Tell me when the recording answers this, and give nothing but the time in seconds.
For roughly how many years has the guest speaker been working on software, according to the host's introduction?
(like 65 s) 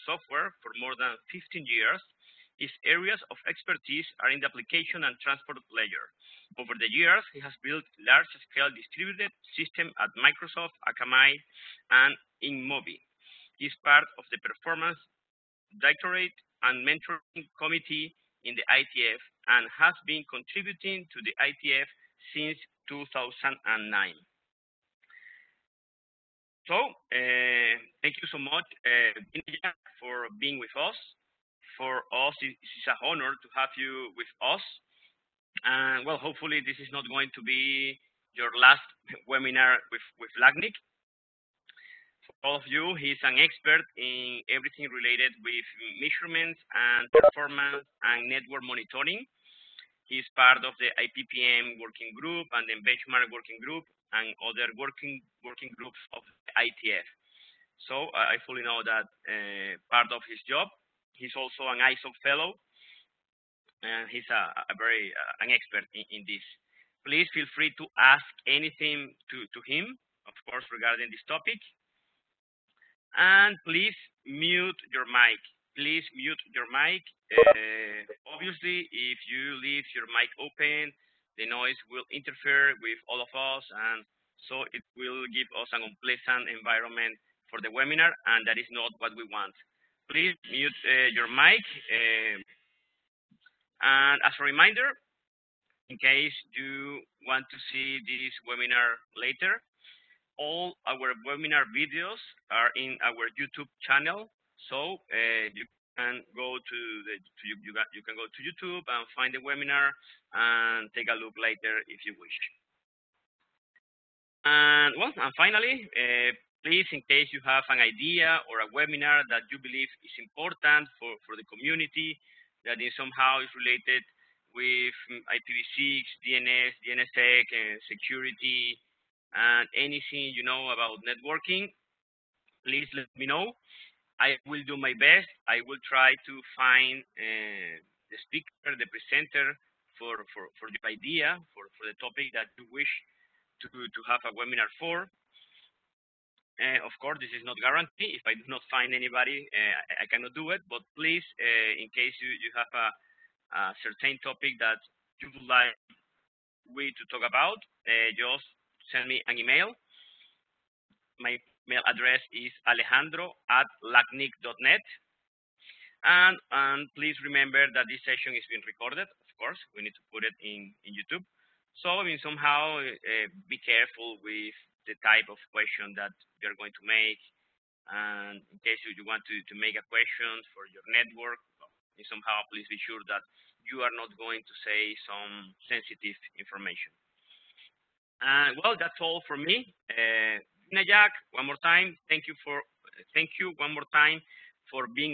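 0 s.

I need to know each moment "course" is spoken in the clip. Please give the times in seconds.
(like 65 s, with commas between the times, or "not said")
70 s, 146 s, 169 s.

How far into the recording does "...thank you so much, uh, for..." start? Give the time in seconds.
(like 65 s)
28 s.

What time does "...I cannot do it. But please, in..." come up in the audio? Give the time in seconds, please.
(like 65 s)
150 s.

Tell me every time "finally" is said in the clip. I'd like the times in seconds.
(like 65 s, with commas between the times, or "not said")
115 s.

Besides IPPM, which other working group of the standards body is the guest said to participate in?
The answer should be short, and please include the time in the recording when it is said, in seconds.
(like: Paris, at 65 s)
benchmark working group, at 52 s.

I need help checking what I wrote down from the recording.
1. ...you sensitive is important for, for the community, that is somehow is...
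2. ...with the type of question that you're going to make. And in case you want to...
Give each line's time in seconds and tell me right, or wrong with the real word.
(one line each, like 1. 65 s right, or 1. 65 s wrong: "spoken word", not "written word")
1. 119 s wrong: "believe", not "sensitive"
2. 174 s right.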